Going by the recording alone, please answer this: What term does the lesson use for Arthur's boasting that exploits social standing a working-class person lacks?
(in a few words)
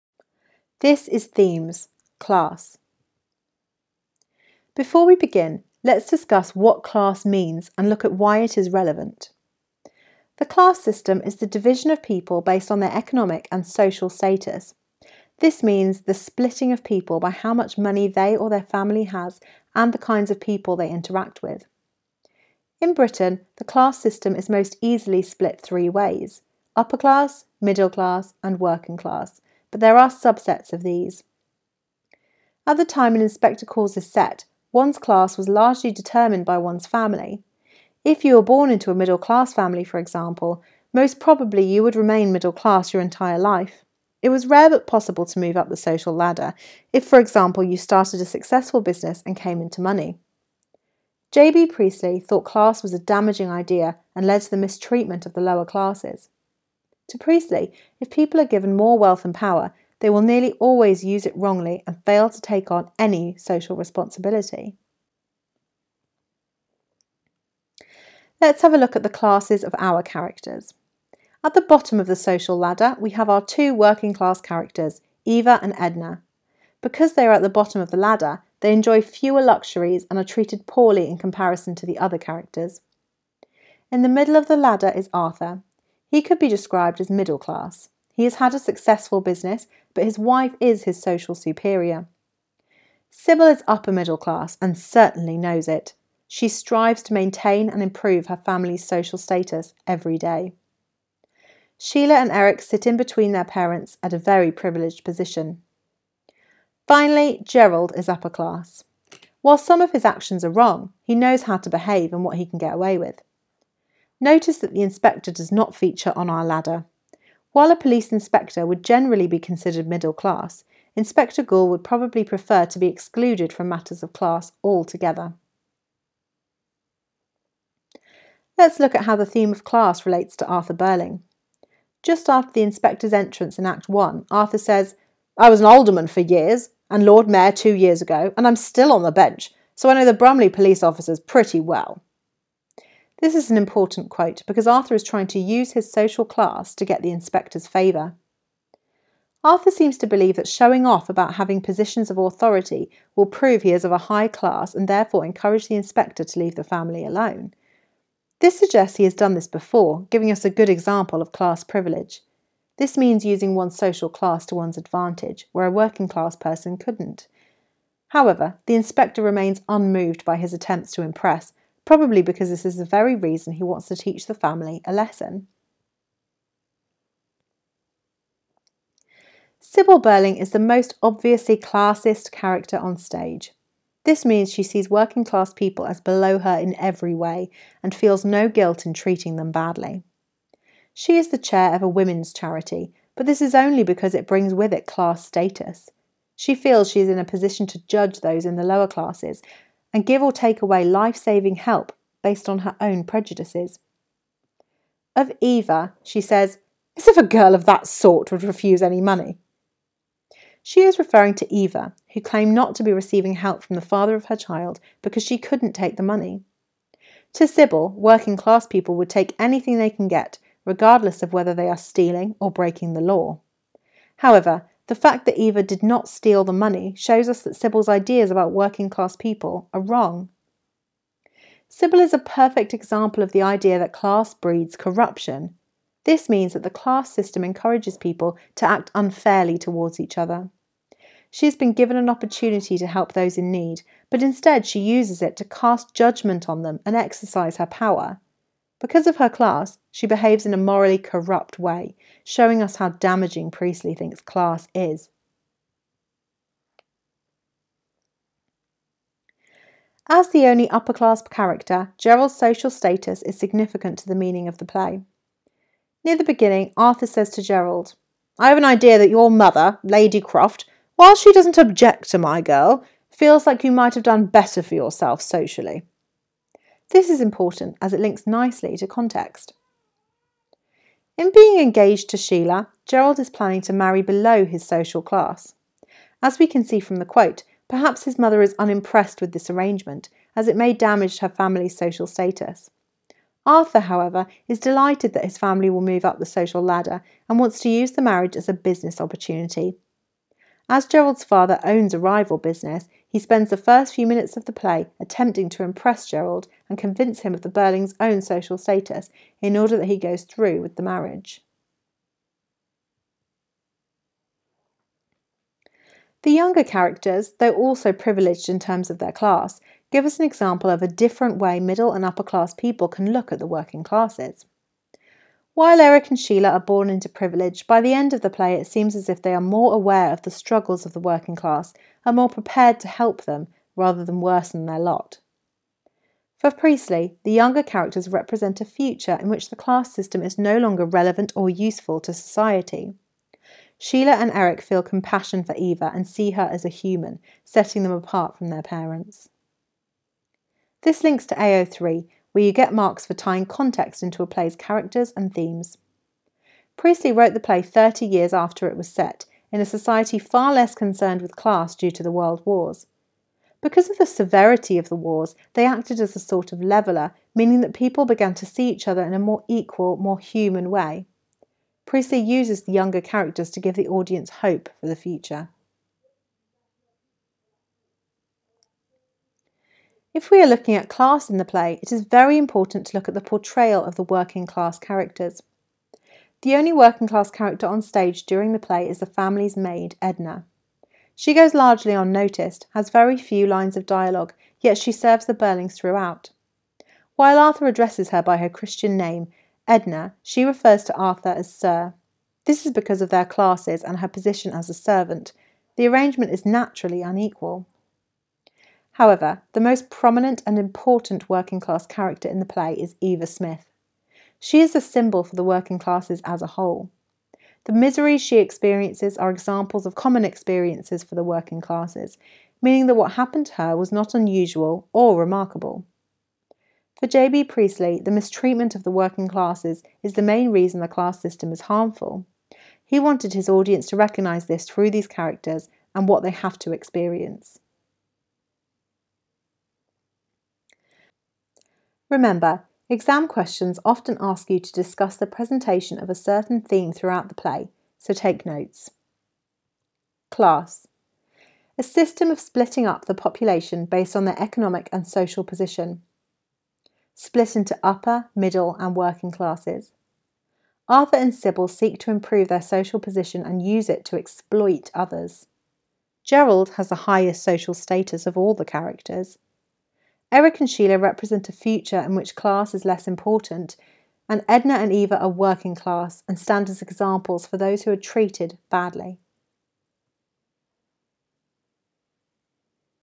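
class privilege.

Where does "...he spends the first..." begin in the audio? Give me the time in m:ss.
5:03.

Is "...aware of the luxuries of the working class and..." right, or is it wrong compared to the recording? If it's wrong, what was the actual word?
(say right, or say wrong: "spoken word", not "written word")
wrong: "struggles", not "luxuries".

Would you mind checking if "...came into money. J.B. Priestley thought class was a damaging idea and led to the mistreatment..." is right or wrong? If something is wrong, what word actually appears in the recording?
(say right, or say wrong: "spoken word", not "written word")
right.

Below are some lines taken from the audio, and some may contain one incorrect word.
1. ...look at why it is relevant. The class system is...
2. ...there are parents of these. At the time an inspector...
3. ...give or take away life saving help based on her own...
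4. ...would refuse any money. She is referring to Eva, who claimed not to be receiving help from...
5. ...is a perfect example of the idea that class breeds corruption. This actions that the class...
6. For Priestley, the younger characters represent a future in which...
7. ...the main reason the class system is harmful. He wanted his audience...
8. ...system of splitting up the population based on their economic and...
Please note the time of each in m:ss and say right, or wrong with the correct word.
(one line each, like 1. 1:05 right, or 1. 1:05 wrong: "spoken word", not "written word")
1. 0:07 right
2. 0:29 wrong: "subsets", not "parents"
3. 3:20 right
4. 3:28 right
5. 3:52 wrong: "means", not "actions"
6. 5:36 right
7. 7:10 right
8. 7:31 right.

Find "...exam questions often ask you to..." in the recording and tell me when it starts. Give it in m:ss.
7:22.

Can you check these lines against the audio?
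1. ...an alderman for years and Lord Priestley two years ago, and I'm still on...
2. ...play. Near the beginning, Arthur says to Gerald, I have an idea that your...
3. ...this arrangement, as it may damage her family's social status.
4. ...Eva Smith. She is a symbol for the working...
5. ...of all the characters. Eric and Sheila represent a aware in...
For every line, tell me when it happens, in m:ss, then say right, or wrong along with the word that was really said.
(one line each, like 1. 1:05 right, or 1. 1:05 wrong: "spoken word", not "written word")
1. 2:15 wrong: "Mayor", not "Priestley"
2. 4:24 right
3. 4:49 right
4. 6:53 right
5. 7:48 wrong: "future", not "aware".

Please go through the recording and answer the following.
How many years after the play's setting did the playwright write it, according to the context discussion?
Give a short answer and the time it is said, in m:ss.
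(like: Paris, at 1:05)
30, at 5:57.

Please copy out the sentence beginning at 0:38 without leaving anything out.
If you were born into a middle class family, for example, most probably you would remain middle class your entire life.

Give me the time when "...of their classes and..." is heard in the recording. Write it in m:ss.
6:43.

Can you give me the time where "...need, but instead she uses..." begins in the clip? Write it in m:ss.
4:03.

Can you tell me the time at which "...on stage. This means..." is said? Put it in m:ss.
3:02.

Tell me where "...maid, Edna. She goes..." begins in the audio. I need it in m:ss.
6:29.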